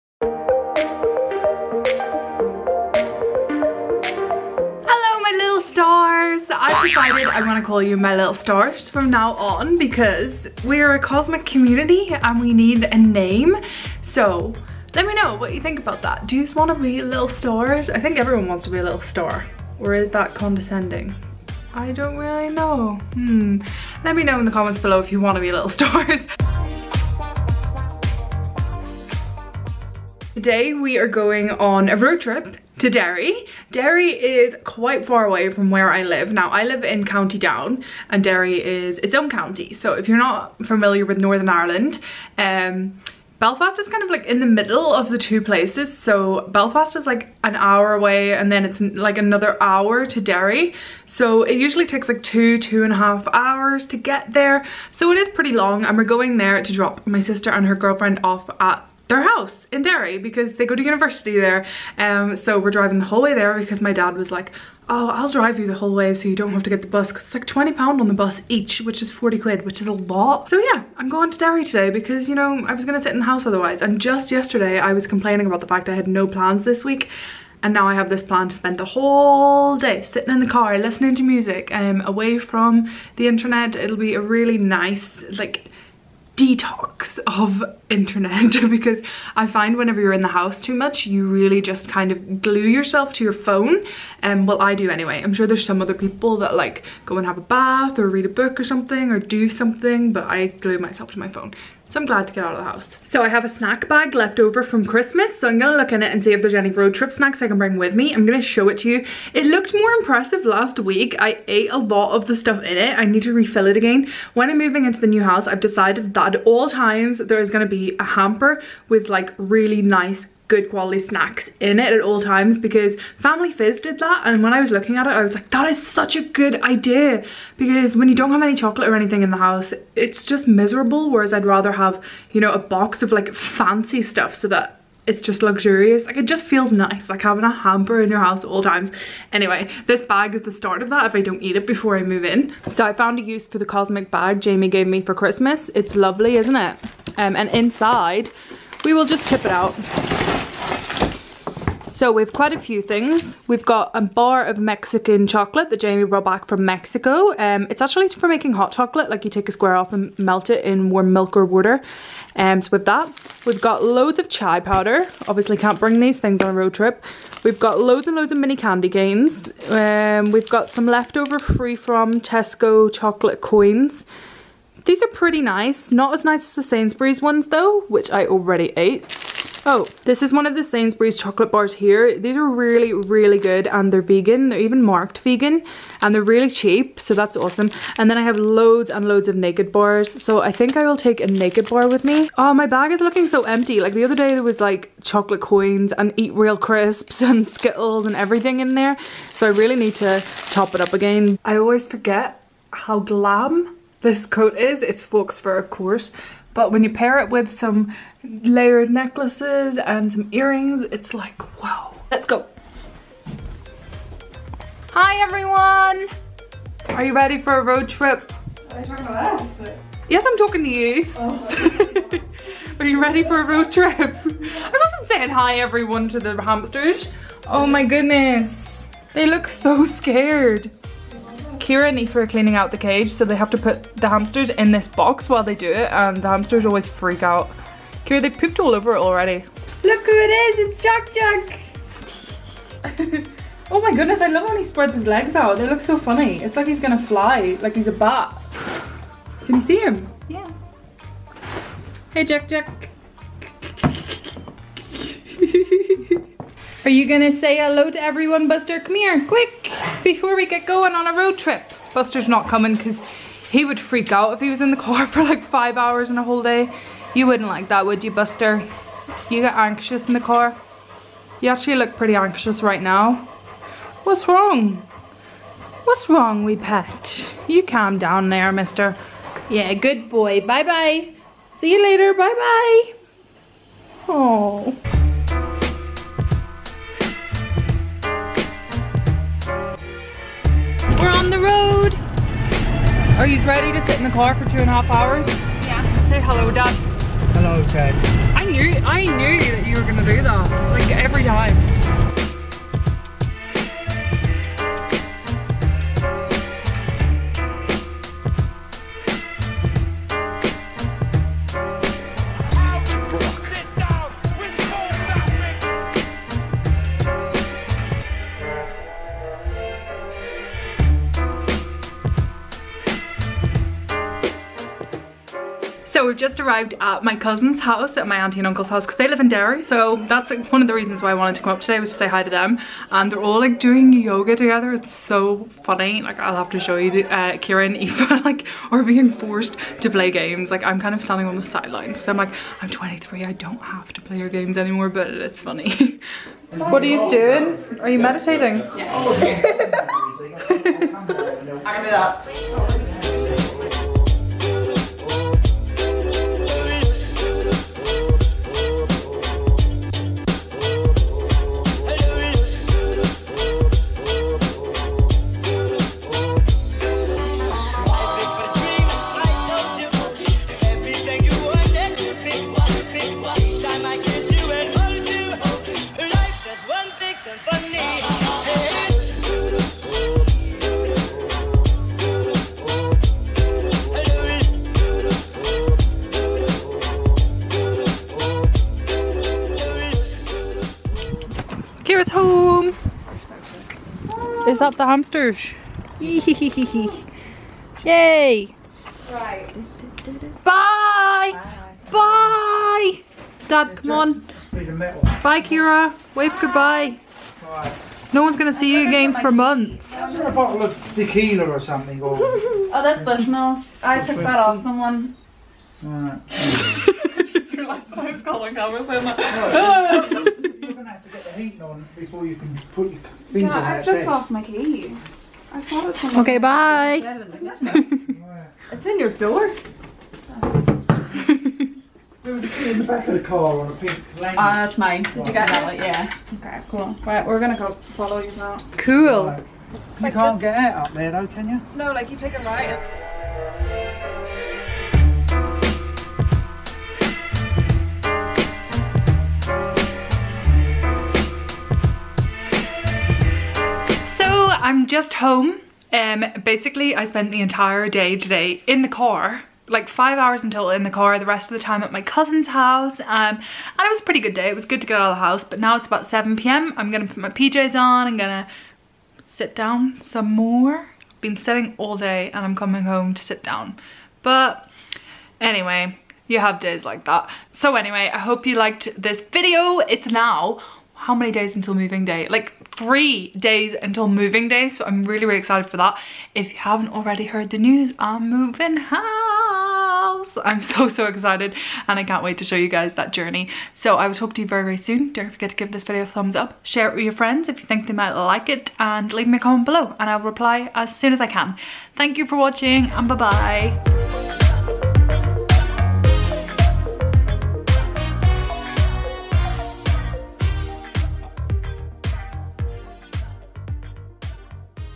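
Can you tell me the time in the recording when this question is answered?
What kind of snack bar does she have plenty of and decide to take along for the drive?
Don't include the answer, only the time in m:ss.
3:11.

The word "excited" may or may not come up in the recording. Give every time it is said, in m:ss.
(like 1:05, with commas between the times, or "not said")
8:05, 8:11.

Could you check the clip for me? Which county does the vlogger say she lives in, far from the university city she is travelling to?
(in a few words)
County Down.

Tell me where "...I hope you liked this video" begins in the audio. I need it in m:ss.
7:58.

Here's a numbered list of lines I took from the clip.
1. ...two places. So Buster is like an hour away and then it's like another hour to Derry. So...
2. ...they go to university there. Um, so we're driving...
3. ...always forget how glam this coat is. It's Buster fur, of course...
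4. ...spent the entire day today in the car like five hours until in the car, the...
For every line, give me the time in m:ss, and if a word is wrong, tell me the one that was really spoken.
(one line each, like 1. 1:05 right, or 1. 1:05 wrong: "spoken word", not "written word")
1. 0:45 wrong: "Belfast", not "Buster"
2. 1:00 right
3. 3:21 wrong: "Fox", not "Buster"
4. 7:37 right.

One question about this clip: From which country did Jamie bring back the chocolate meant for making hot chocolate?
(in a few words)
Mexico.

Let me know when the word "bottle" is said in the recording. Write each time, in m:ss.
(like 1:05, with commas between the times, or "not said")
6:50.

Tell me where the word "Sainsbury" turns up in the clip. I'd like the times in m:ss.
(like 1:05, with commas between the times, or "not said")
2:56, 3:00.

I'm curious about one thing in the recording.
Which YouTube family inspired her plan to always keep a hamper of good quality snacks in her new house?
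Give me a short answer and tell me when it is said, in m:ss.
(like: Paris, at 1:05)
Family Fizz, at 2:03.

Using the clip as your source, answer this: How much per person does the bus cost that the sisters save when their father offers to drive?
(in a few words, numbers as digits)
20 pounds.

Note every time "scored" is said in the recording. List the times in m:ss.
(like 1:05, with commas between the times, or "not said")
not said.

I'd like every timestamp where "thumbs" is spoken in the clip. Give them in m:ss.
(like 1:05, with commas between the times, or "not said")
8:16.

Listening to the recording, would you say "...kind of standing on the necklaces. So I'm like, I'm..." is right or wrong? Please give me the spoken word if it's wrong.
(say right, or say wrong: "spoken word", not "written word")
wrong: "sidelines", not "necklaces".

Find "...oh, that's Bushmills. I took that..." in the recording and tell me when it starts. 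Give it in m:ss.
6:52.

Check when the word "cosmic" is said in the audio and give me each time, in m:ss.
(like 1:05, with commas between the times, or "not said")
0:10, 2:23.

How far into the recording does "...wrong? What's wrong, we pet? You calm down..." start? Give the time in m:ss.
4:34.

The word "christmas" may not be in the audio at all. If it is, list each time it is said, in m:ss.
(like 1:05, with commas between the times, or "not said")
1:44, 2:25.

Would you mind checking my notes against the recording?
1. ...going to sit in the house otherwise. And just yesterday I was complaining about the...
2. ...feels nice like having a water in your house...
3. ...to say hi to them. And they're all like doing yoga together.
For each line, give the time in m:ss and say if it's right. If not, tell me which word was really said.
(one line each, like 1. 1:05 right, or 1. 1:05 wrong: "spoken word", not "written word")
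1. 1:12 right
2. 2:16 wrong: "hamper", not "water"
3. 5:31 right.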